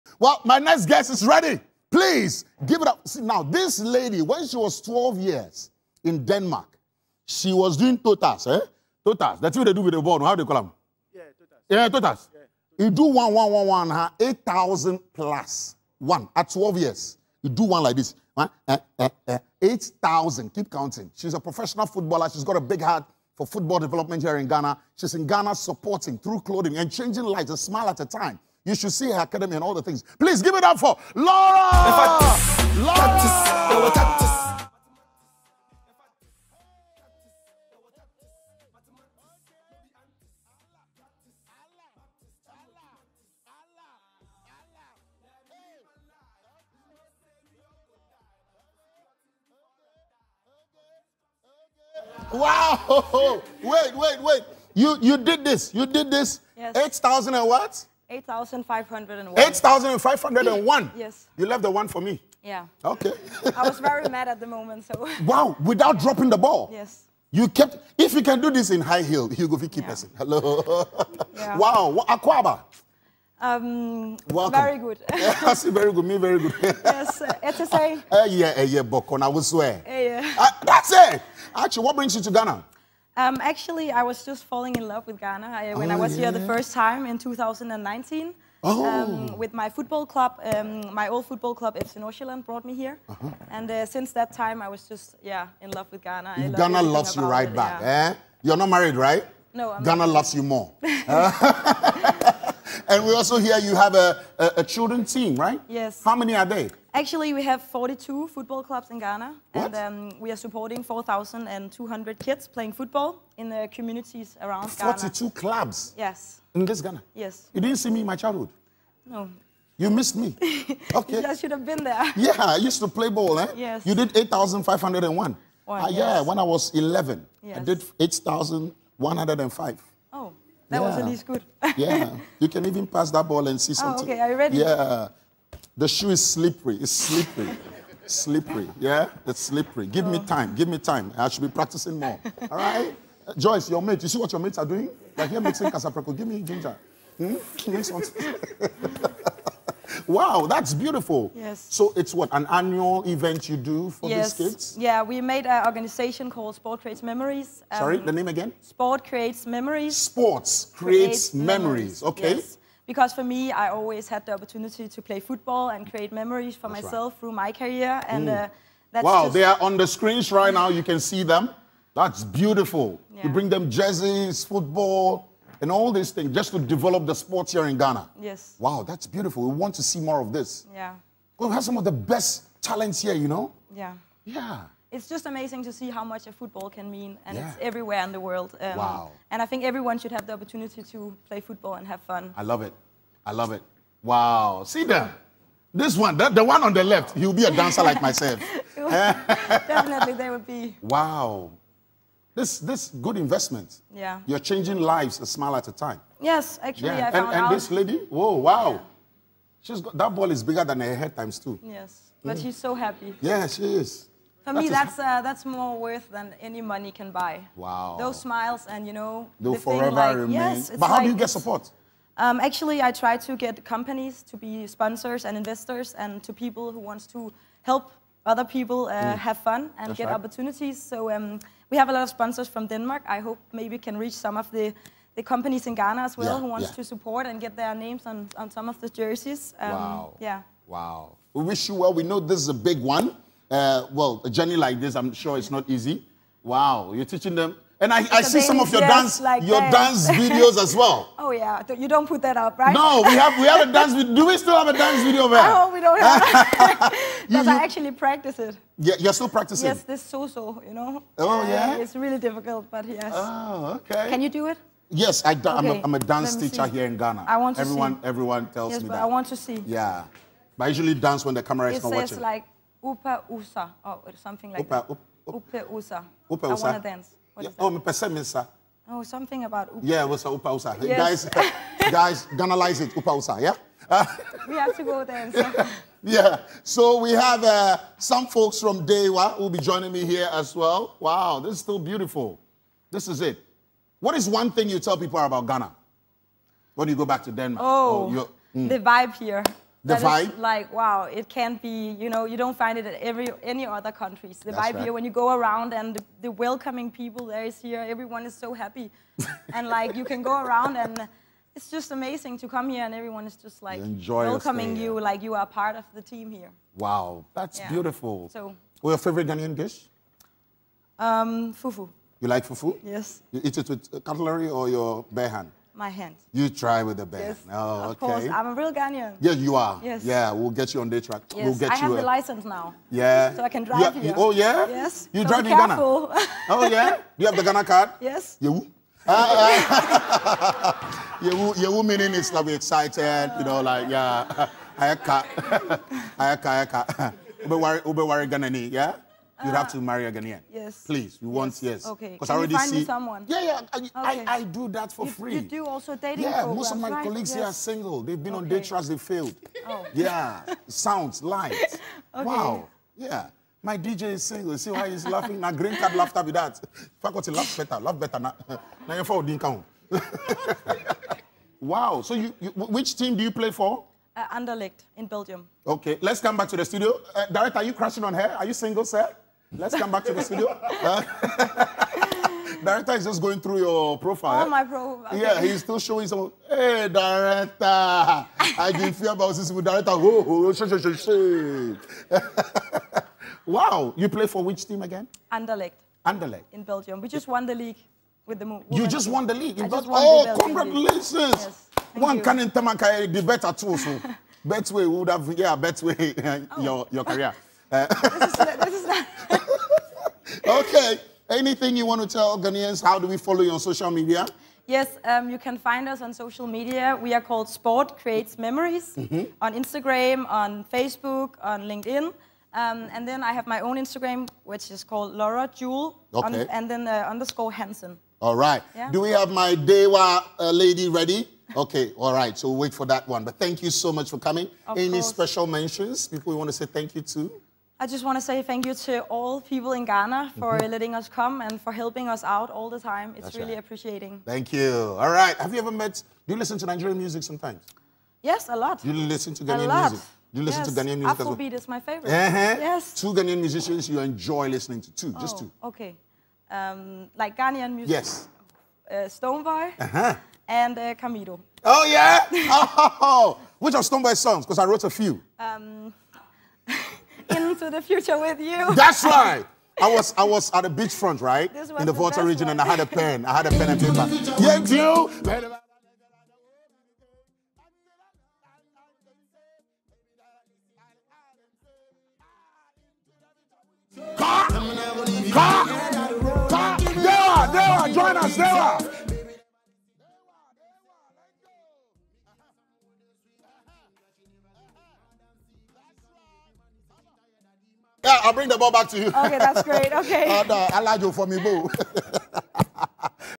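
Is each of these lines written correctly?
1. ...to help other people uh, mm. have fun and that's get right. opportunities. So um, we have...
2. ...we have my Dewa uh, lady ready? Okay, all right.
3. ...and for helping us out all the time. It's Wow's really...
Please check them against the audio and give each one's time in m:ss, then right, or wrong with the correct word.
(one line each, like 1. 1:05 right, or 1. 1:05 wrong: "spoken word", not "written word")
1. 3:47 right
2. 7:09 right
3. 7:21 wrong: "That", not "Wow".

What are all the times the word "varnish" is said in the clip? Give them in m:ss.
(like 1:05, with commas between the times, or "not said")
not said.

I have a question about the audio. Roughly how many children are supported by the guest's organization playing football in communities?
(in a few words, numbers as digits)
4,200.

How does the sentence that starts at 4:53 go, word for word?
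What is one thing you tell people about Ghana?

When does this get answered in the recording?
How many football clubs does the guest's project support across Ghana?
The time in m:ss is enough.
1:47.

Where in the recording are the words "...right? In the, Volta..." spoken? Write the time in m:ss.
7:51.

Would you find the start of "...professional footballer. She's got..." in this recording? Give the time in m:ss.
0:21.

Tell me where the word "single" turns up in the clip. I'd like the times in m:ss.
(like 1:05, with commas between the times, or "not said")
5:57, 6:04, 6:18.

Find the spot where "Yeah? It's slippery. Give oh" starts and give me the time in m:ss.
2:18.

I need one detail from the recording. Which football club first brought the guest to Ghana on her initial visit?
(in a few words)
FC Nordsjælland.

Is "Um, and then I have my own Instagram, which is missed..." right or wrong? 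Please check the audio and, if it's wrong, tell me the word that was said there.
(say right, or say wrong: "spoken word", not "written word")
wrong: "called", not "missed".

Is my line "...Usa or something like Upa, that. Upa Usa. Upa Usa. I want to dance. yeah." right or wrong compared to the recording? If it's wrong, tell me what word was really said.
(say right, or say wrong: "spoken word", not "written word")
right.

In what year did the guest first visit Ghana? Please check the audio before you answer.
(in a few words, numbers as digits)
2019.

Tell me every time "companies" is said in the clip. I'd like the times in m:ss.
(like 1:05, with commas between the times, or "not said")
3:43, 3:55.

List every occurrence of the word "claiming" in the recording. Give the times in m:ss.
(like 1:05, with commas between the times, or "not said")
not said.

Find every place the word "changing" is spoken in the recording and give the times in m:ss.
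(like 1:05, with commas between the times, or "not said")
0:26, 3:24.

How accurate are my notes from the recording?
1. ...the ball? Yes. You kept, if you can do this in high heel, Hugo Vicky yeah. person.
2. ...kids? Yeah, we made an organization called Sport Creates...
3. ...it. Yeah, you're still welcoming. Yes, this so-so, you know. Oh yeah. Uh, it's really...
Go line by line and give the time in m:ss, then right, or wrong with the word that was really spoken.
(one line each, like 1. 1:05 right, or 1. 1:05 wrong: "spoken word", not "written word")
1. 1:06 right
2. 2:34 right
3. 4:18 wrong: "practicing", not "welcoming".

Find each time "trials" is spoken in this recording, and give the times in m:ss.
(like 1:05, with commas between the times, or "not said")
5:58.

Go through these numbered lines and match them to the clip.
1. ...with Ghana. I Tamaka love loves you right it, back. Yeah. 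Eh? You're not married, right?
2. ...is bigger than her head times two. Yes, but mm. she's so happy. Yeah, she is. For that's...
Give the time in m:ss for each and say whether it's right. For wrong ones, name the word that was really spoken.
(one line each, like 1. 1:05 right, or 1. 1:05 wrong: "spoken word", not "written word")
1. 1:35 wrong: "Ghana", not "Tamaka"
2. 3:30 right.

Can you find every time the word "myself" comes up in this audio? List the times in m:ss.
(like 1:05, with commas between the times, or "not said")
2:46, 3:18.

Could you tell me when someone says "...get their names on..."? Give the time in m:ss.
3:57.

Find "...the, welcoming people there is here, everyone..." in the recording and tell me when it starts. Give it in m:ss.
5:06.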